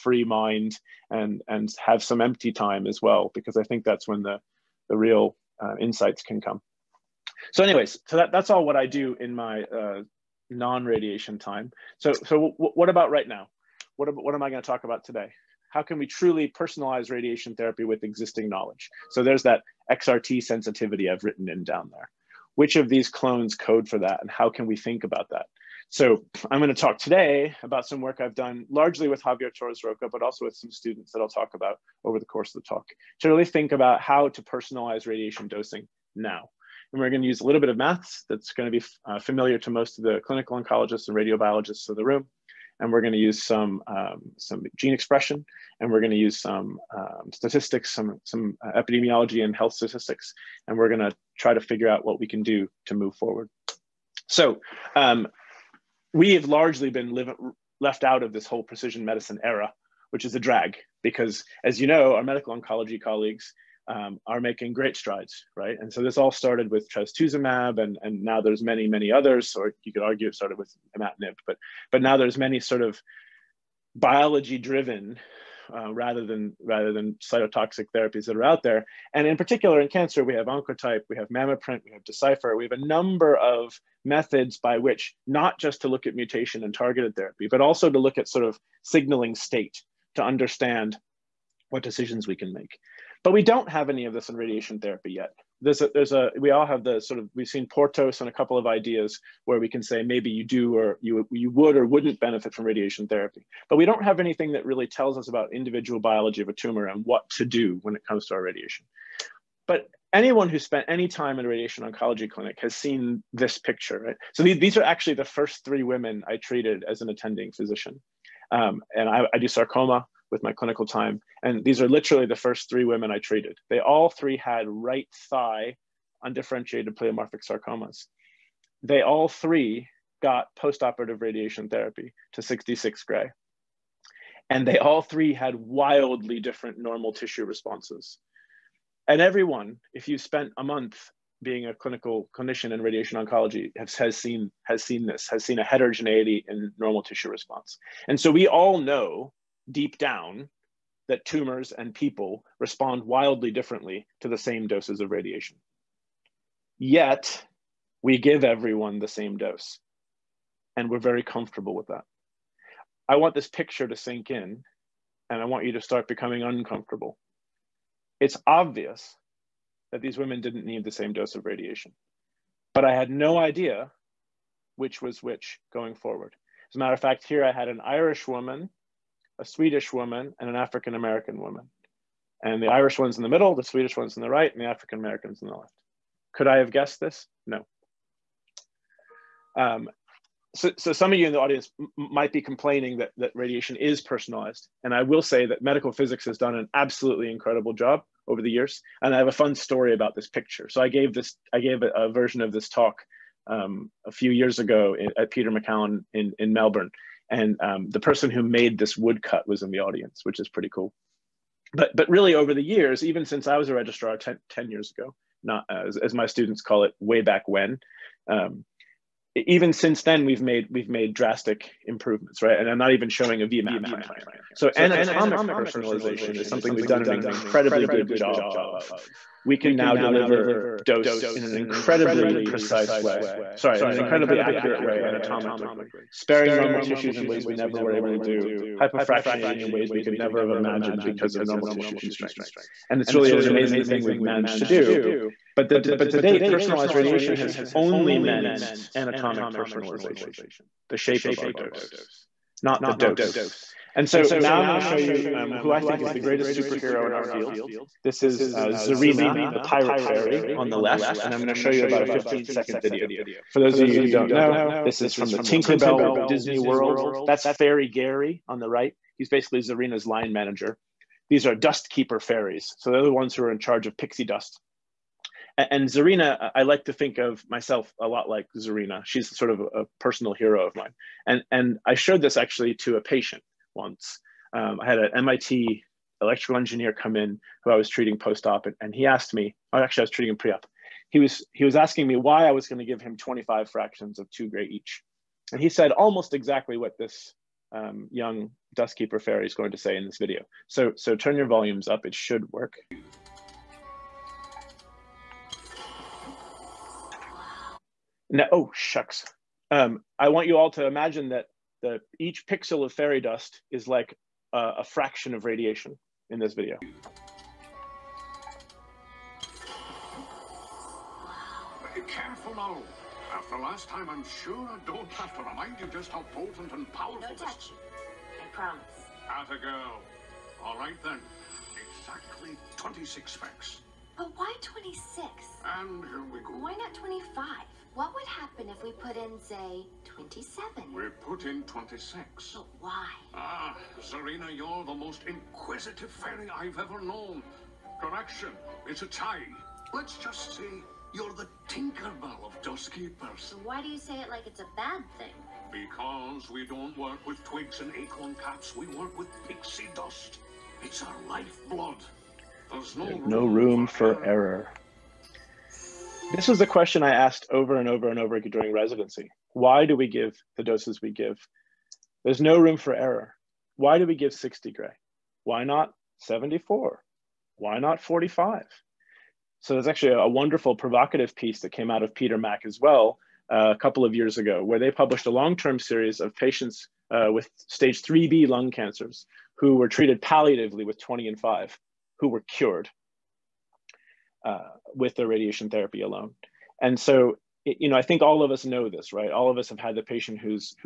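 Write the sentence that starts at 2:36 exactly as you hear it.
Yet, we give everyone the same dose, and we're very comfortable with that.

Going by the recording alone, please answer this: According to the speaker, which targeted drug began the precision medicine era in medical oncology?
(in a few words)
trastuzumab.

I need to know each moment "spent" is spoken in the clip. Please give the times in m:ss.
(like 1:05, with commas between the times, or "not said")
1:50, 2:20.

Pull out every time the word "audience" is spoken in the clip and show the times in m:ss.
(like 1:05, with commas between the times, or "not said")
3:11, 3:29.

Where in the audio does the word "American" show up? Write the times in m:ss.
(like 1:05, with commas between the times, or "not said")
3:00, 3:04.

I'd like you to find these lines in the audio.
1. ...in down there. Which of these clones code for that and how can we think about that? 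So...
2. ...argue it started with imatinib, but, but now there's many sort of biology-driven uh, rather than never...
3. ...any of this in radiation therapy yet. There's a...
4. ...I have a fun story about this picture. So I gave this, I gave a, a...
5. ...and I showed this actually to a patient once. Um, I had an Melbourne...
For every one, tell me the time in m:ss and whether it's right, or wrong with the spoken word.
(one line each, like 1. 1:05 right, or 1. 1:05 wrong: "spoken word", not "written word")
1. 0:21 right
2. 1:10 wrong: "rather", not "never"
3. 1:33 right
4. 3:19 right
5. 4:41 wrong: "MIT", not "Melbourne".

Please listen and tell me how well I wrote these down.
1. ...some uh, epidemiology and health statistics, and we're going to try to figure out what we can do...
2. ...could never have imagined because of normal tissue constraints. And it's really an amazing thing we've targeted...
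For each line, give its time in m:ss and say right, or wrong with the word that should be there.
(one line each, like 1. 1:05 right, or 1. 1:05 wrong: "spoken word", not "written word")
1. 0:48 right
2. 4:00 wrong: "managed", not "targeted".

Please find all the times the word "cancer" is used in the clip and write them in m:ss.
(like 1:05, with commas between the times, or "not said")
1:19, 6:28.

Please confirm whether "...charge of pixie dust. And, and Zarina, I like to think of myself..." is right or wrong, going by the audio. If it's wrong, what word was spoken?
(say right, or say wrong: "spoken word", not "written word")
right.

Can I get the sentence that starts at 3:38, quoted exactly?
Um, even since then, we've made we've made drastic improvements, right?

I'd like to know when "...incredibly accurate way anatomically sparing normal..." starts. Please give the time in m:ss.
3:53.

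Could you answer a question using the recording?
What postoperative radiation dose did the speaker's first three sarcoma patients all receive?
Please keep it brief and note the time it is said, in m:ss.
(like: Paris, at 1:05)
66 Gy, at 2:12.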